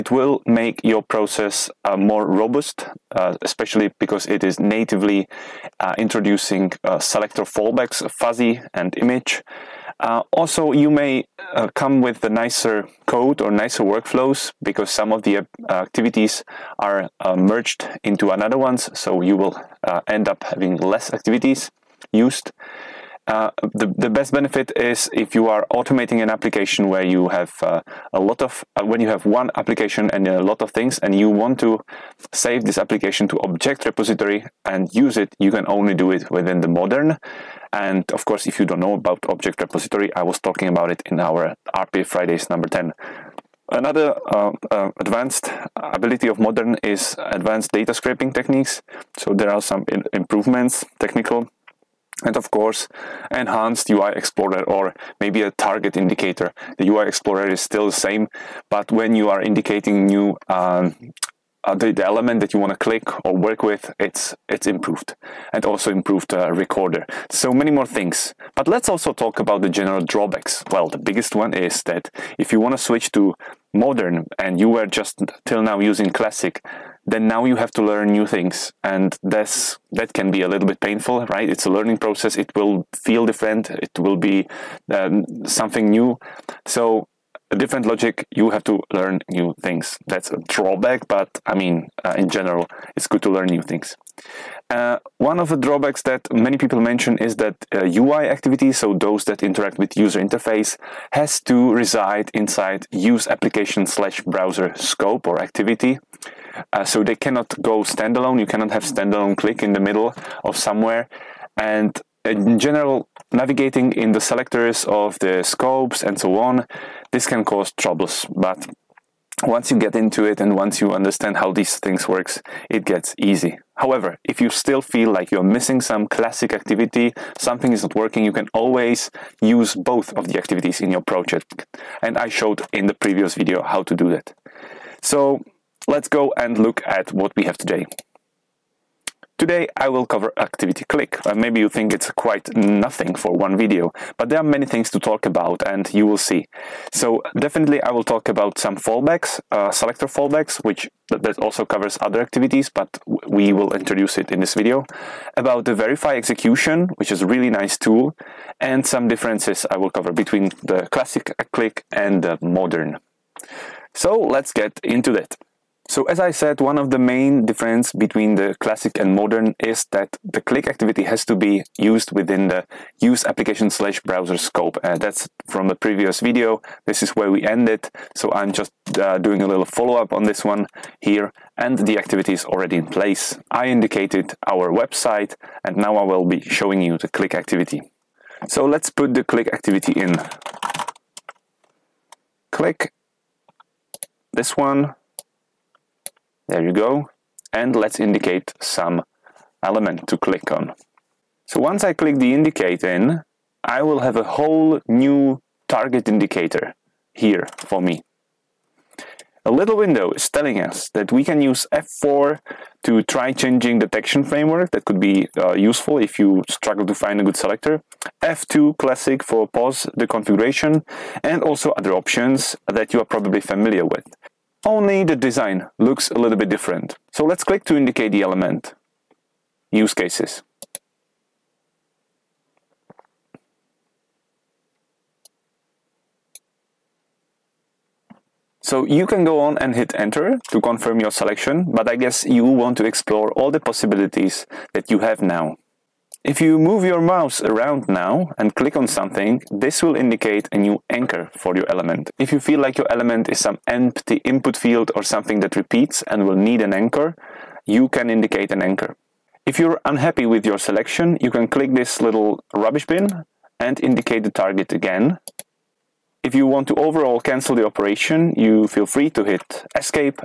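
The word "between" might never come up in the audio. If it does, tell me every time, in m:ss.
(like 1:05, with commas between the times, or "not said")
2:40, 2:47.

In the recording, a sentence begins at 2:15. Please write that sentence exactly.
So let's go and look at what we have today.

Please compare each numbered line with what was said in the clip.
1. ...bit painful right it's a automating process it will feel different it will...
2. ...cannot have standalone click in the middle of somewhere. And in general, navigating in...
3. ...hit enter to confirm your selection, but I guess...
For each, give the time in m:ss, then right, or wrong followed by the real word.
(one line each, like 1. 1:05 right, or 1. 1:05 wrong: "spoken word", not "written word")
1. 1:20 wrong: "learning", not "automating"
2. 1:48 right
3. 3:59 right.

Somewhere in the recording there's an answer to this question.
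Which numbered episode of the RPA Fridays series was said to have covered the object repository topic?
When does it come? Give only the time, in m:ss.
0:42.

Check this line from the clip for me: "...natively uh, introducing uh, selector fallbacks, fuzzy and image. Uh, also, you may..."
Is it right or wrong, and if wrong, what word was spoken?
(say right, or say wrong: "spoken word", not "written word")
right.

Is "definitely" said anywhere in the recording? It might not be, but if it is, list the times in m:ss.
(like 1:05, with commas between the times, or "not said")
2:27.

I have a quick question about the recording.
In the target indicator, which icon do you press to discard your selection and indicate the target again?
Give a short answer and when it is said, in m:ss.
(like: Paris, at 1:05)
Rubbish bin, at 4:22.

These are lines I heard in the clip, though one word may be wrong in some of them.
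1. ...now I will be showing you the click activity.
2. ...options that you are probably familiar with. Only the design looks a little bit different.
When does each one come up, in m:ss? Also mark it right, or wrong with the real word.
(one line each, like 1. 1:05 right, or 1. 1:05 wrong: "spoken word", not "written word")
1. 3:05 right
2. 3:41 right.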